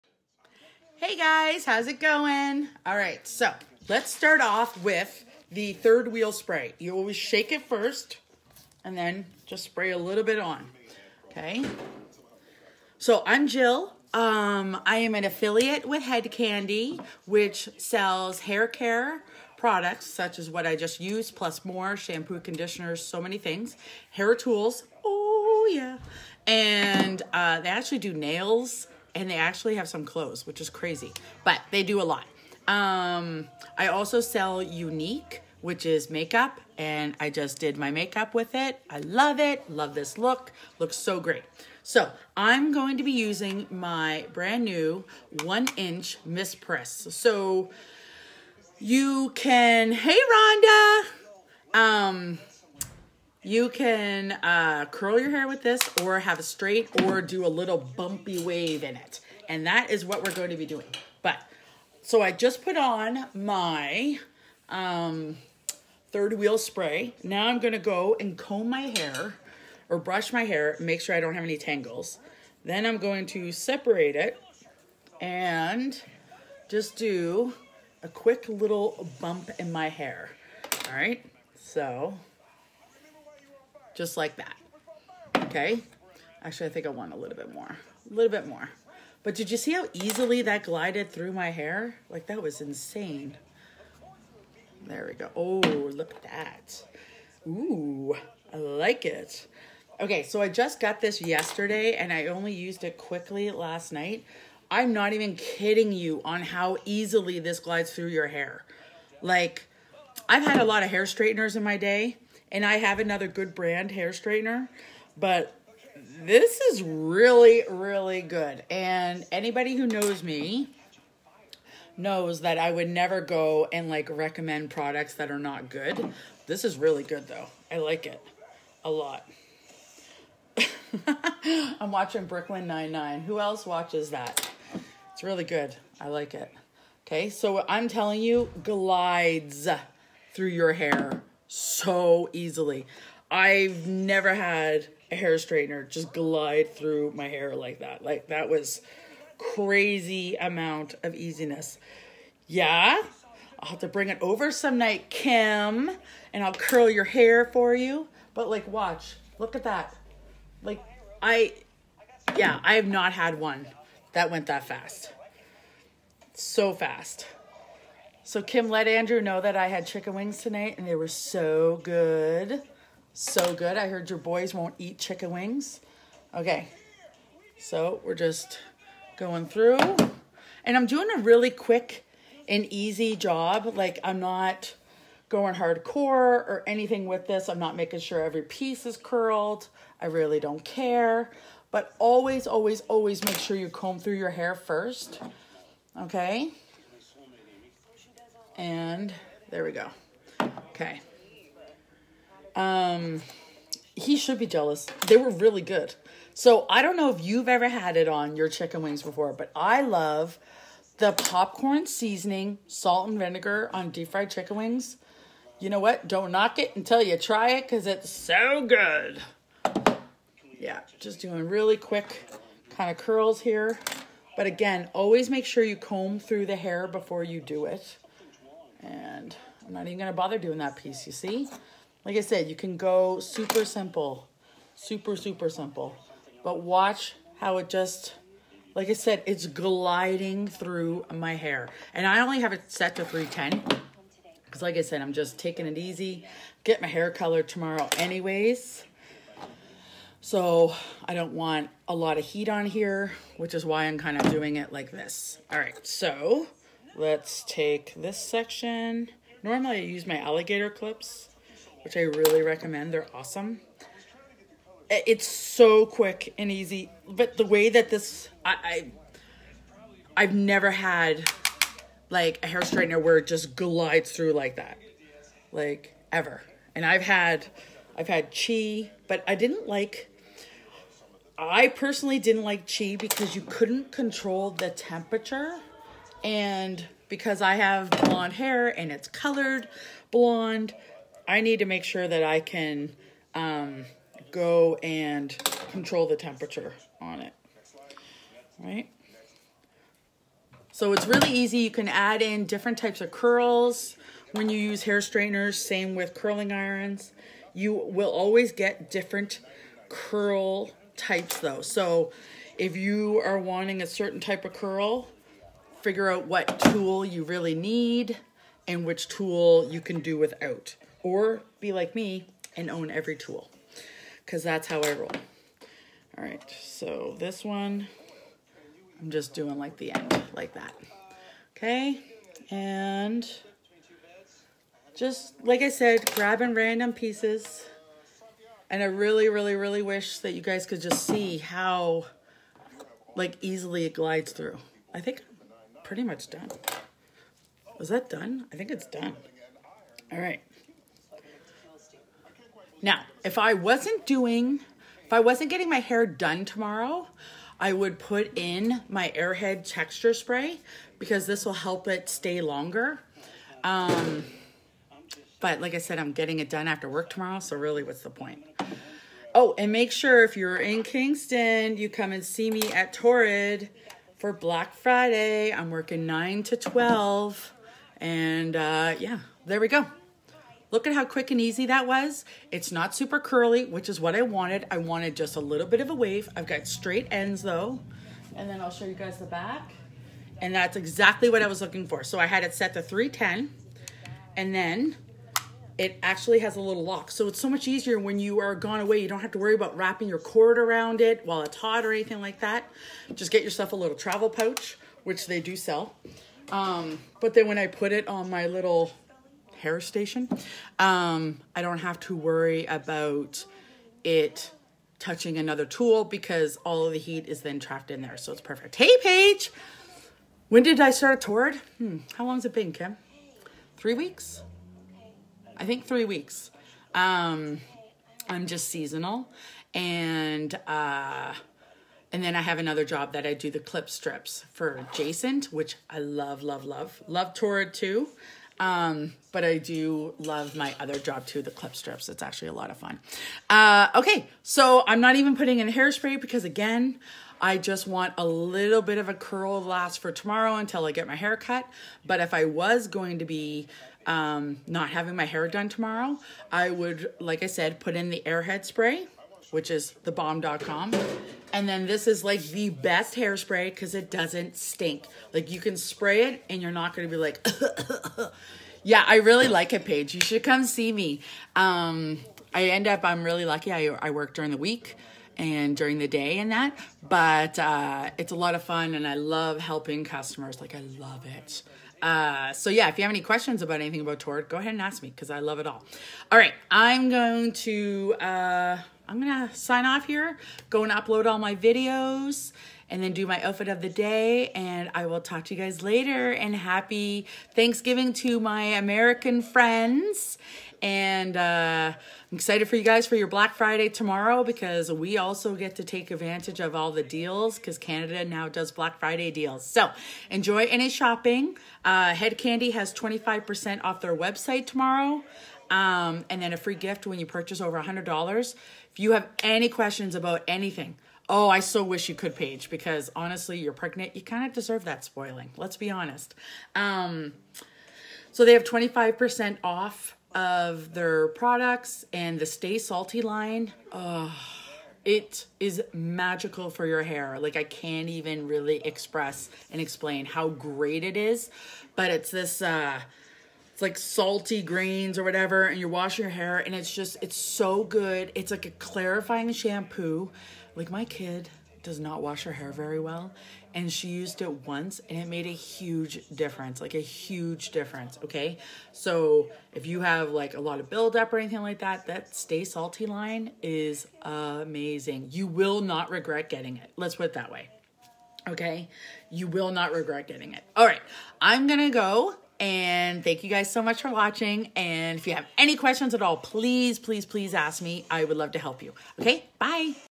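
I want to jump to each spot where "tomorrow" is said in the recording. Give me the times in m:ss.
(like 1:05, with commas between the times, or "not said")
4:07, 5:56, 6:07, 7:30, 7:35, 8:23, 8:34.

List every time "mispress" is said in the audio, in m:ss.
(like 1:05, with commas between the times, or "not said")
0:46.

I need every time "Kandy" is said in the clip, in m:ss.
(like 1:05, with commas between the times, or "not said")
0:16, 8:32.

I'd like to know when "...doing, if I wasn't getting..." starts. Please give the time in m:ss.
5:54.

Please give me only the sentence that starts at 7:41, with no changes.
And then this is like the best hairspray because it doesn't stink.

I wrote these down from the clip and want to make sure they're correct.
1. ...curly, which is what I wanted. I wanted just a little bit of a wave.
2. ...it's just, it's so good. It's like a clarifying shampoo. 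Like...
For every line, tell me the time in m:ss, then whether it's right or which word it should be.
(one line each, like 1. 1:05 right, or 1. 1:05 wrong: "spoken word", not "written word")
1. 6:23 right
2. 9:06 right.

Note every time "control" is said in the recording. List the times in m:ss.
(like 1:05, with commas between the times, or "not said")
4:43, 4:55.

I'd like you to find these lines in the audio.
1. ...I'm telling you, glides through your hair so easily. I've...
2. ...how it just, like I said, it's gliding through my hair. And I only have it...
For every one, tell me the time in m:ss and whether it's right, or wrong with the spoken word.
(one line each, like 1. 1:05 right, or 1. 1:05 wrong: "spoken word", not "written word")
1. 2:17 right
2. 3:57 right.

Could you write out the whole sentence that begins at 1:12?
Then I'm going to separate it and just do a quick little bump in my hair.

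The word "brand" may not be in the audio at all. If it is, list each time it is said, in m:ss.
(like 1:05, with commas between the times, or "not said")
0:44, 1:53.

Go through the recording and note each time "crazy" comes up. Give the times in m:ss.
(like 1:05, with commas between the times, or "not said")
0:30, 2:29.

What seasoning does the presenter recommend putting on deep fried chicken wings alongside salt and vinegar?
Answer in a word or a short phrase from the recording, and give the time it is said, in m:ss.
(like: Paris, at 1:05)
popcorn seasoning, at 3:31.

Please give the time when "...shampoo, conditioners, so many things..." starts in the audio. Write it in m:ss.
0:21.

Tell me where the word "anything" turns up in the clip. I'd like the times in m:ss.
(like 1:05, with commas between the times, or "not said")
3:06, 6:41, 8:03, 8:40, 9:21.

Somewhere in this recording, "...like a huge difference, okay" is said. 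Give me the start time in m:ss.
9:16.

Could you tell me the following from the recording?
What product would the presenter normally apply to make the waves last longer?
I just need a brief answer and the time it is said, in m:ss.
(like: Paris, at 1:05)
Airhead texture spray, at 5:59.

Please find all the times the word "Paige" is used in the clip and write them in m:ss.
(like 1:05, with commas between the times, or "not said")
6:59, 7:49, 8:42.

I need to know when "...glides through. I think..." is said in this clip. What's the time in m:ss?
5:43.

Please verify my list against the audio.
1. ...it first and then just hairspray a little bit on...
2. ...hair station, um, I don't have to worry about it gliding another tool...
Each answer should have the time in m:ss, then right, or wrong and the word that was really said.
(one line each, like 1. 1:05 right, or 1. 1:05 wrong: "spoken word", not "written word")
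1. 0:07 wrong: "spray", not "hairspray"
2. 6:49 wrong: "touching", not "gliding".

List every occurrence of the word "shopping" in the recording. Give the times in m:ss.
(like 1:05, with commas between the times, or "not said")
8:30.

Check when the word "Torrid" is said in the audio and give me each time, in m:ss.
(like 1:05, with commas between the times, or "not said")
6:12, 7:17.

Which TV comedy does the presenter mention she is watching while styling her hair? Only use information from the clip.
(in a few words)
Brooklyn Nine-Nine.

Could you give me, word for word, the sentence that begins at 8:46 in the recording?
Um, so they have 25% off of their products and the Stay Salty line.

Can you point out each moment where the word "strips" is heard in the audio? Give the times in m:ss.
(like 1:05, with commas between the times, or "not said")
7:13, 7:21.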